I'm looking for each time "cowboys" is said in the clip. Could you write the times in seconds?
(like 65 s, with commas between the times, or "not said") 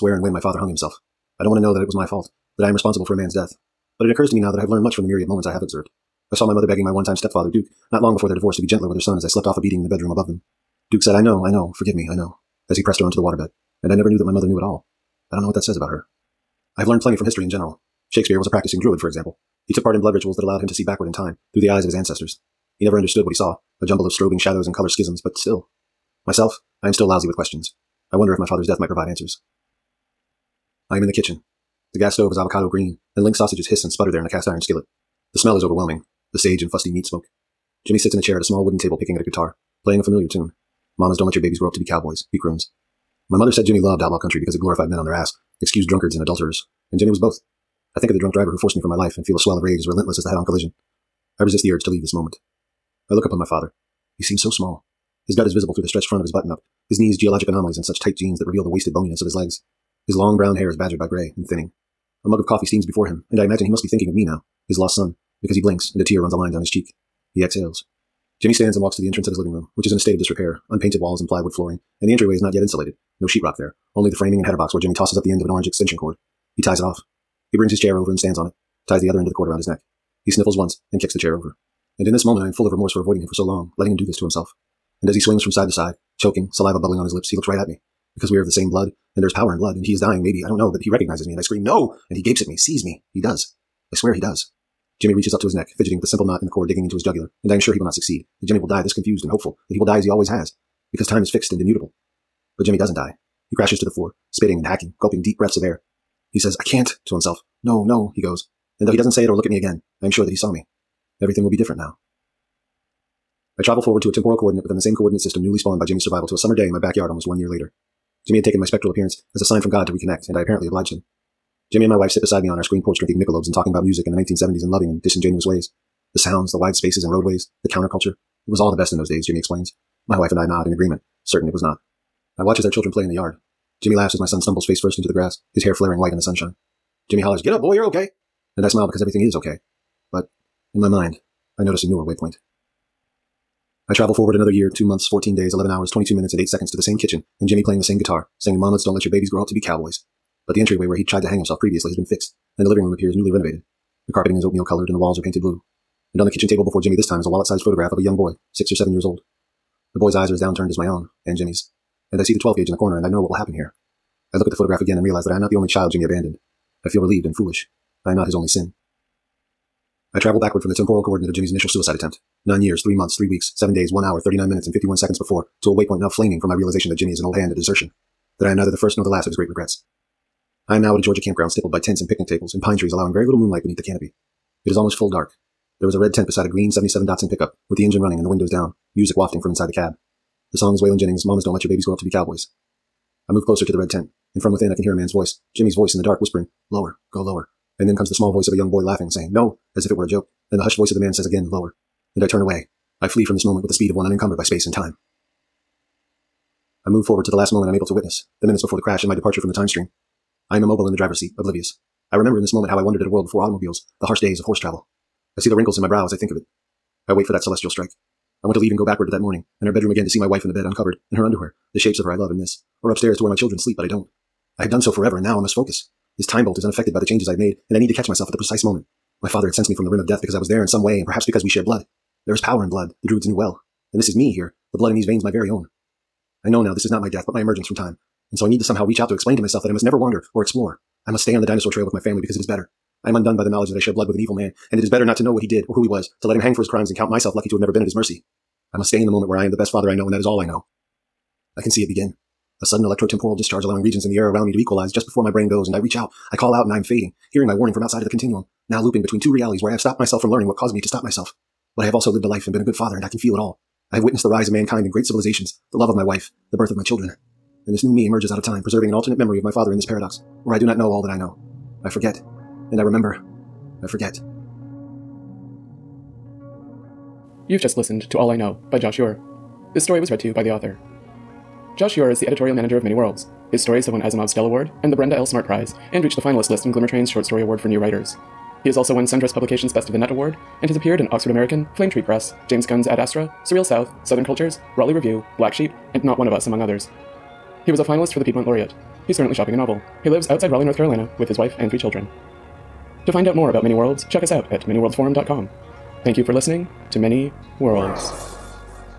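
41 s, 149 s, 192 s.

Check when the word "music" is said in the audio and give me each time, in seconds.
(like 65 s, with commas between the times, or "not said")
123 s, 188 s.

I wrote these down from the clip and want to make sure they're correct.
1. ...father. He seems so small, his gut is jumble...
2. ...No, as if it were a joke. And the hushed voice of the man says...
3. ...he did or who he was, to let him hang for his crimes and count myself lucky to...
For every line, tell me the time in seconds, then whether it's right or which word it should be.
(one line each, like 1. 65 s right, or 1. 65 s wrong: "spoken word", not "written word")
1. 53 s wrong: "visible", not "jumble"
2. 199 s right
3. 245 s right.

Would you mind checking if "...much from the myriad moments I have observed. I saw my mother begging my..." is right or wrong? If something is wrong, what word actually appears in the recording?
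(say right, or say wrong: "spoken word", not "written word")
right.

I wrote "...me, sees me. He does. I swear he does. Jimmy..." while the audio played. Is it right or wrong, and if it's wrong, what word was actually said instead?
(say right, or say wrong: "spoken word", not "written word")
right.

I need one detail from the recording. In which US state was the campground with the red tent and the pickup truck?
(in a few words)
Georgia.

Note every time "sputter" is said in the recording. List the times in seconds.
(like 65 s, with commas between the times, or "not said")
33 s.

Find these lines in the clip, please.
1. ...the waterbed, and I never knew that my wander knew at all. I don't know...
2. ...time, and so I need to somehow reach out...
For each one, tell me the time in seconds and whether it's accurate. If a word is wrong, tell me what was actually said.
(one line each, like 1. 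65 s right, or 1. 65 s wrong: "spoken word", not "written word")
1. 13 s wrong: "mother", not "wander"
2. 237 s right.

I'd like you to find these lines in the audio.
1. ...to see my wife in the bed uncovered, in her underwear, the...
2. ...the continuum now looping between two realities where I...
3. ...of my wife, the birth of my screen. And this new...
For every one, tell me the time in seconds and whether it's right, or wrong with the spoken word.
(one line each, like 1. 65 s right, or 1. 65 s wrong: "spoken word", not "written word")
1. 220 s right
2. 258 s right
3. 265 s wrong: "children", not "screen".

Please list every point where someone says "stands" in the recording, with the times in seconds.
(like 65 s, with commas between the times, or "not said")
68 s, 78 s.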